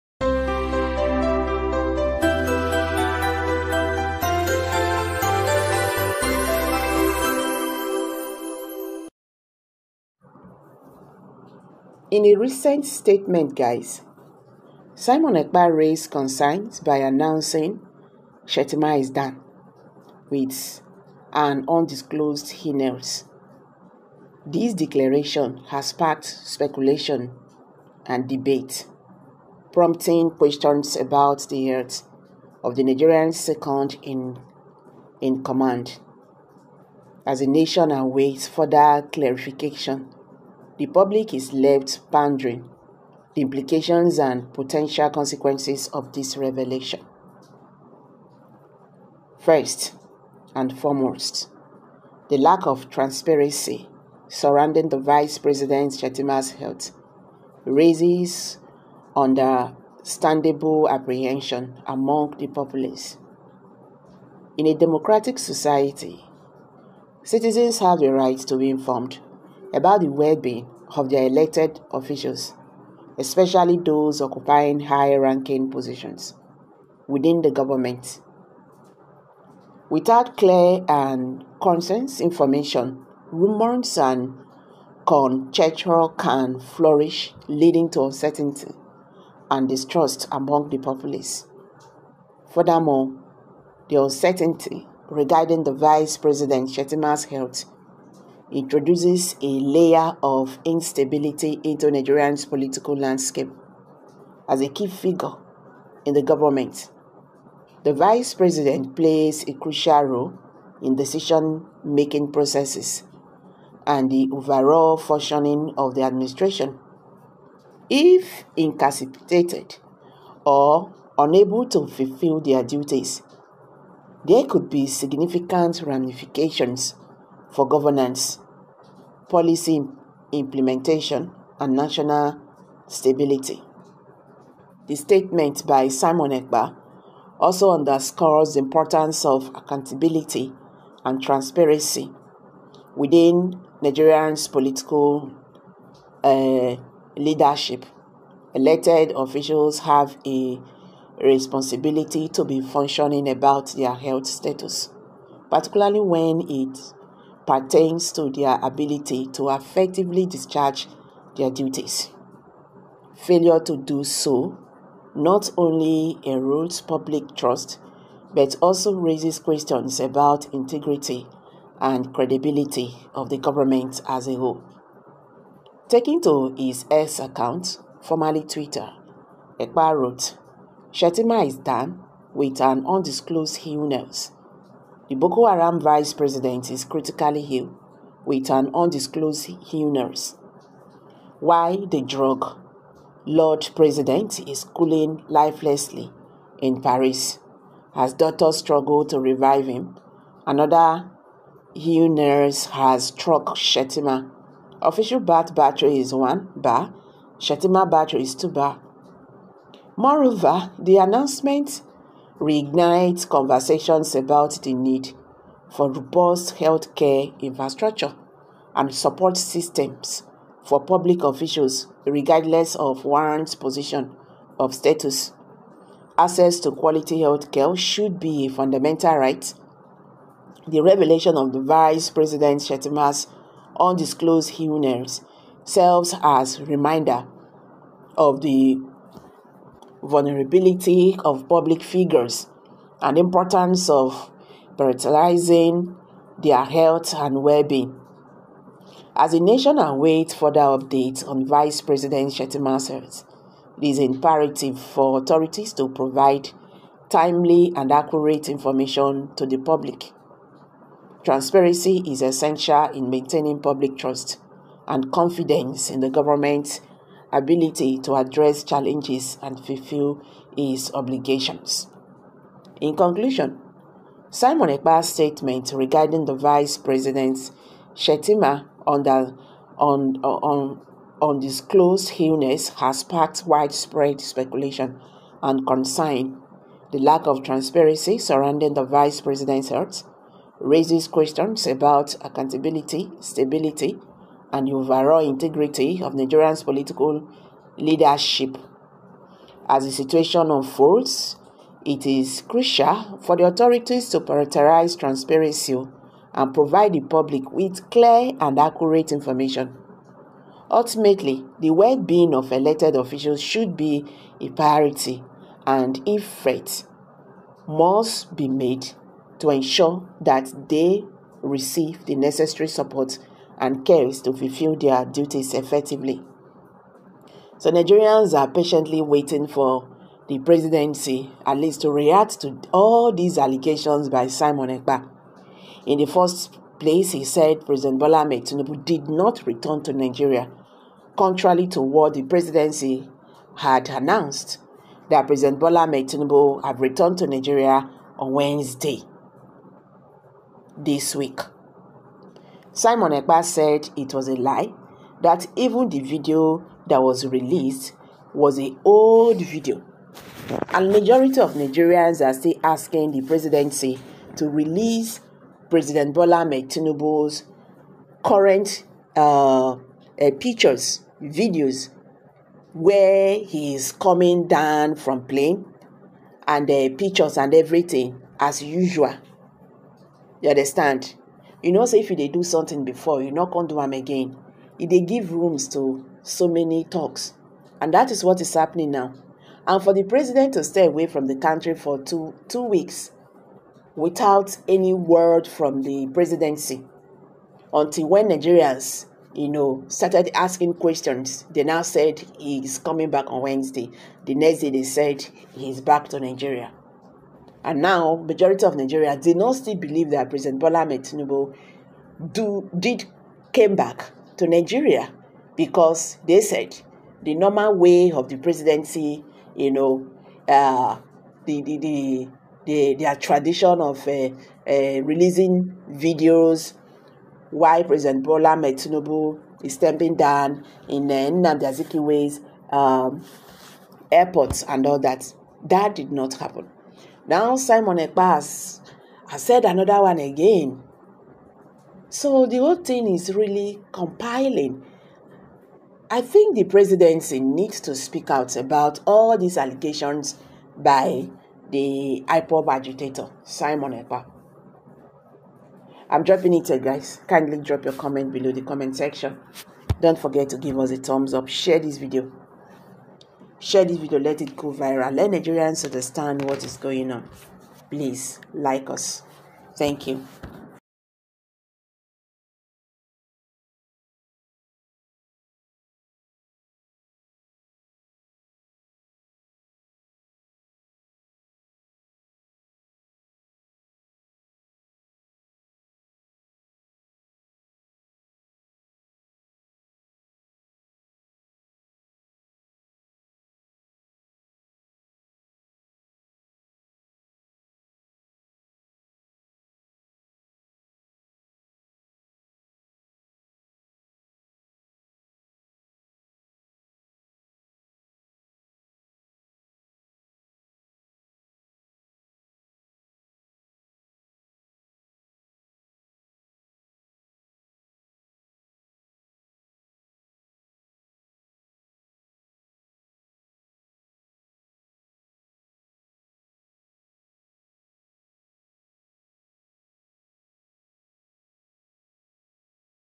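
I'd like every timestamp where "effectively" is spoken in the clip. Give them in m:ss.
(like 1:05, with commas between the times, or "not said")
2:39, 5:25.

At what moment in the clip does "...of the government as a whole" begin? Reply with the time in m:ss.
2:53.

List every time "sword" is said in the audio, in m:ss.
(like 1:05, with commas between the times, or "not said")
not said.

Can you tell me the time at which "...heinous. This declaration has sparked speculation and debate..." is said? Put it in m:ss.
0:22.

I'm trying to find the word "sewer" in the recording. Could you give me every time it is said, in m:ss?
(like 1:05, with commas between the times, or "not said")
not said.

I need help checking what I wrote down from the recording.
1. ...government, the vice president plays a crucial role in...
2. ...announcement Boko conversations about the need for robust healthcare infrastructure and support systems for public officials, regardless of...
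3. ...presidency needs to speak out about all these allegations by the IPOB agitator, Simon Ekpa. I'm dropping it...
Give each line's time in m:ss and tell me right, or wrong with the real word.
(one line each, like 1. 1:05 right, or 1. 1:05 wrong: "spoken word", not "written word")
1. 1:46 right
2. 3:30 wrong: "Reignite", not "Boko"
3. 7:26 right.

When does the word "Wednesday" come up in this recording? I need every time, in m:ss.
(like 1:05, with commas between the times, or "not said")
5:48, 6:43.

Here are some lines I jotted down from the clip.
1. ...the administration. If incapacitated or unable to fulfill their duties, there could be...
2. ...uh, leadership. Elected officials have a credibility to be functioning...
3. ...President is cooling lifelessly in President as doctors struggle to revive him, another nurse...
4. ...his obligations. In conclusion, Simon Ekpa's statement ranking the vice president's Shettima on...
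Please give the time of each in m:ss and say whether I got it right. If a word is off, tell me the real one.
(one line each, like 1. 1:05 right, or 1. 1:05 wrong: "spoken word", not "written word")
1. 1:55 right
2. 2:26 wrong: "responsibility", not "credibility"
3. 3:13 wrong: "Paris", not "President"
4. 4:30 wrong: "regarding", not "ranking".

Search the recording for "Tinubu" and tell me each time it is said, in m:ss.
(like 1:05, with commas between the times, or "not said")
5:38, 5:45, 6:06, 6:50, 7:08.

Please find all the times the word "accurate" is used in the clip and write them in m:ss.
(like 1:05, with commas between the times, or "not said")
4:17, 5:08.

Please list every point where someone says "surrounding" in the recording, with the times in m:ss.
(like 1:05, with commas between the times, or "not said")
0:54, 4:48.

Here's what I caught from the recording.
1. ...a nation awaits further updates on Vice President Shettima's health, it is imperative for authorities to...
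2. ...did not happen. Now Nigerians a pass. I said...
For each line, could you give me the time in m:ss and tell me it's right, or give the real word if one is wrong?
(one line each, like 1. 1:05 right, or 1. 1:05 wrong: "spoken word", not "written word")
1. 4:09 right
2. 7:15 wrong: "Simon", not "Nigerians".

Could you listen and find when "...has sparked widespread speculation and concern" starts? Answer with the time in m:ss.
4:42.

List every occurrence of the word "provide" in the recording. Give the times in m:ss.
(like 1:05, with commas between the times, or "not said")
4:15, 5:06.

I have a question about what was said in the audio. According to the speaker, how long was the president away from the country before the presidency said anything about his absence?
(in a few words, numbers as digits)
2 weeks.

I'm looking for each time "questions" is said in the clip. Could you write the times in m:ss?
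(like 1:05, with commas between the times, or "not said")
0:30, 2:49, 4:51, 6:40.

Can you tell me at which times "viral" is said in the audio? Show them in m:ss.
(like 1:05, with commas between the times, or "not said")
7:44.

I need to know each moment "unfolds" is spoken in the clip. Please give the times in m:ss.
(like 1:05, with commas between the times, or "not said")
5:00.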